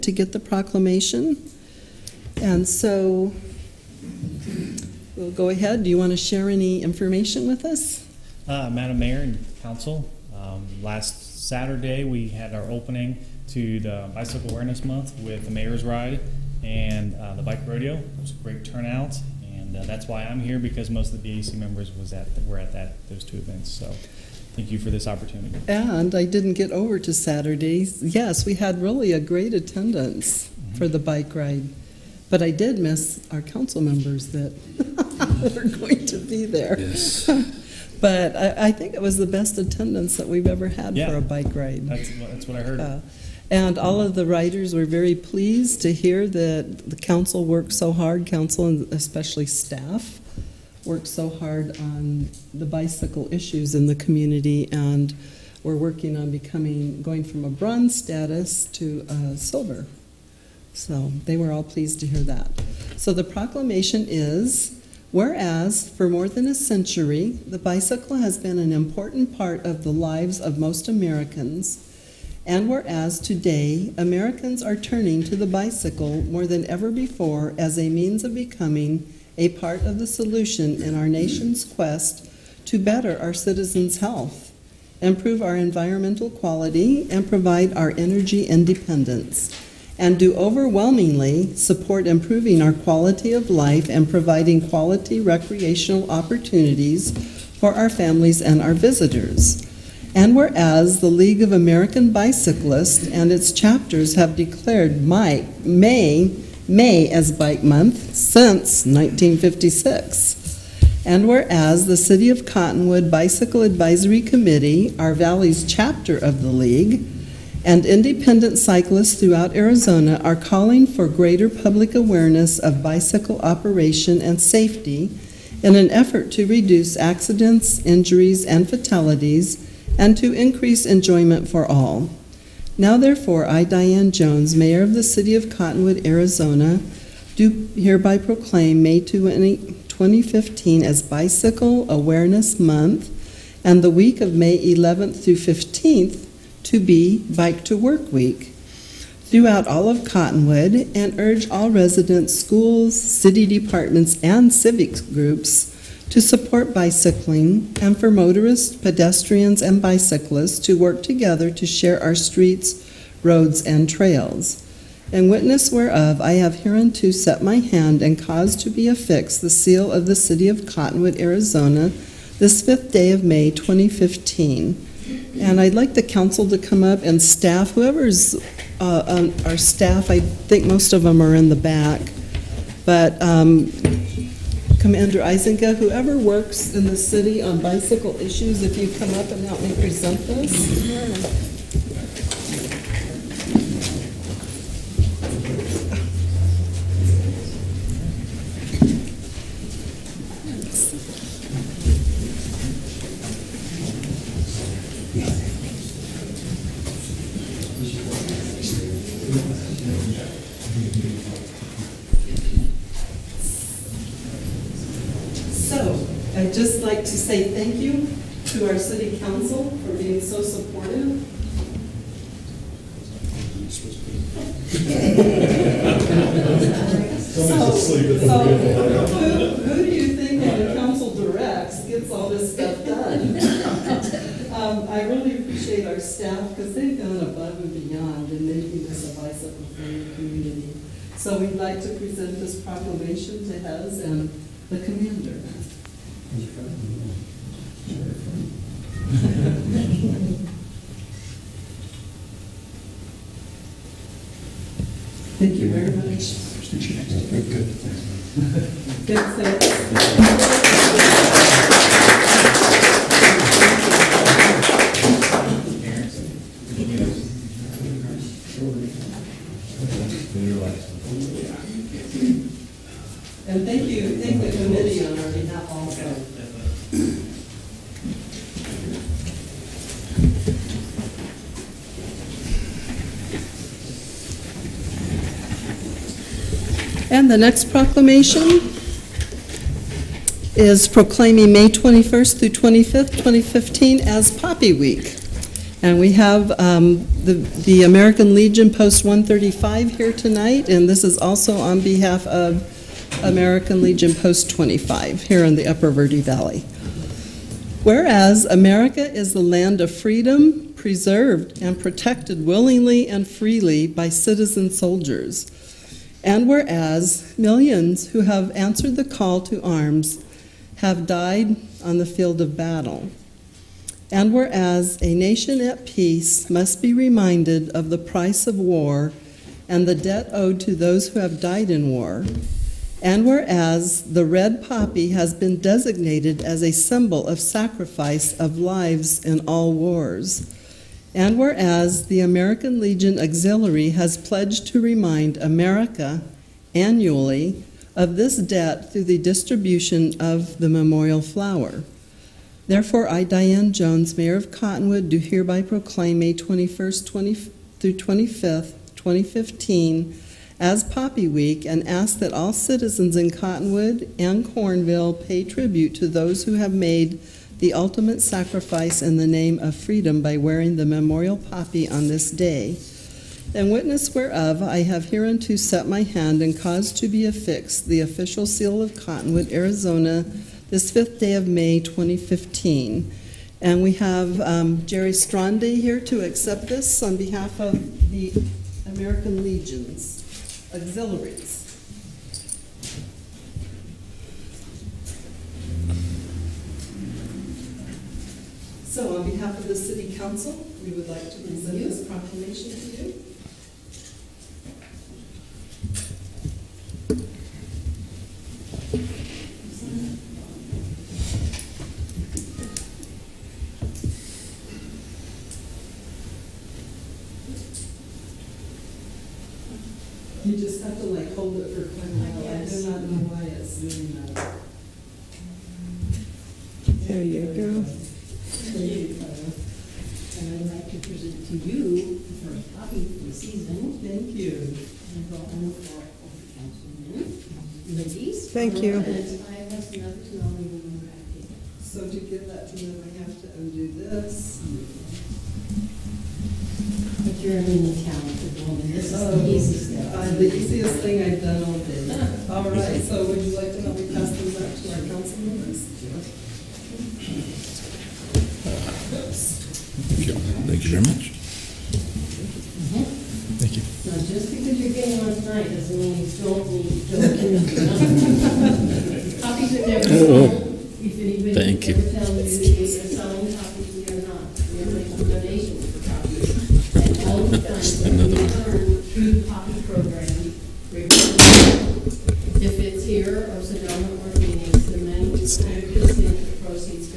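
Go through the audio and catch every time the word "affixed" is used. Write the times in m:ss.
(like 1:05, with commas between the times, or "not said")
2:48, 6:17.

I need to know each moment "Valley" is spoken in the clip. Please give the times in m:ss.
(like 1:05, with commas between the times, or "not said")
1:55, 5:06.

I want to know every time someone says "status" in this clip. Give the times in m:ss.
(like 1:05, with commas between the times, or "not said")
0:57.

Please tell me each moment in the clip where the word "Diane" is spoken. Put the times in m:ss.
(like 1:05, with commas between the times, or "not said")
2:13, 5:53.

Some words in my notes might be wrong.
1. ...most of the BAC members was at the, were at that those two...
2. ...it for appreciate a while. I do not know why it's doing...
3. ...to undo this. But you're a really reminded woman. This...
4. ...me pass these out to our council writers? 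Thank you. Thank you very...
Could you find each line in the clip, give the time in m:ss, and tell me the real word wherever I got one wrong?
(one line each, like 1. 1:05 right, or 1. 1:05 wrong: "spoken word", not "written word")
1. 0:20 right
2. 7:01 wrong: "quite", not "appreciate"
3. 7:23 wrong: "talented", not "reminded"
4. 7:33 wrong: "members", not "writers".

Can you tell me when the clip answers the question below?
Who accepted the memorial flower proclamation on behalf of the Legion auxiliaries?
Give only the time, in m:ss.
6:24.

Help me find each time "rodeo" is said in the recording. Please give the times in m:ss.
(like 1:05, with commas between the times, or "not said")
0:17.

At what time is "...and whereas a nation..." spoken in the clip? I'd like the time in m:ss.
5:24.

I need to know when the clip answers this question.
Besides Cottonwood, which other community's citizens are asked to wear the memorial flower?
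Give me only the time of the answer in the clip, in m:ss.
6:04.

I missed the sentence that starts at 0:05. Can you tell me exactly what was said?
Do you want to share any information with us?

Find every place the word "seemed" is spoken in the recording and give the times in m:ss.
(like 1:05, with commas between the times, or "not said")
not said.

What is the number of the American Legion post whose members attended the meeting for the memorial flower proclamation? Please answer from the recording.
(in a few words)
135.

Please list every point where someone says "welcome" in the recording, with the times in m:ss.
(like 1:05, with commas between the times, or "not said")
not said.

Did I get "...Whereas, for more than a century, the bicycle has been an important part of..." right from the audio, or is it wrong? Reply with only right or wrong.
right.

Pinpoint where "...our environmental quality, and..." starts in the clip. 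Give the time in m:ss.
1:25.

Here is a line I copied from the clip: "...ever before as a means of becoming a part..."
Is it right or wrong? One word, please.
right.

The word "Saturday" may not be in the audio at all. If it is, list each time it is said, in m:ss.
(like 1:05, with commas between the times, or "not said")
0:11, 0:27.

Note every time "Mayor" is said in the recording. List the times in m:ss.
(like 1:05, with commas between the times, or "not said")
0:08, 0:15, 2:14, 5:54.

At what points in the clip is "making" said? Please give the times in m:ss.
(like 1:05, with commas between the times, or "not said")
3:58, 7:54.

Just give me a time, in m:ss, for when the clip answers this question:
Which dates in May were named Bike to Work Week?
2:24.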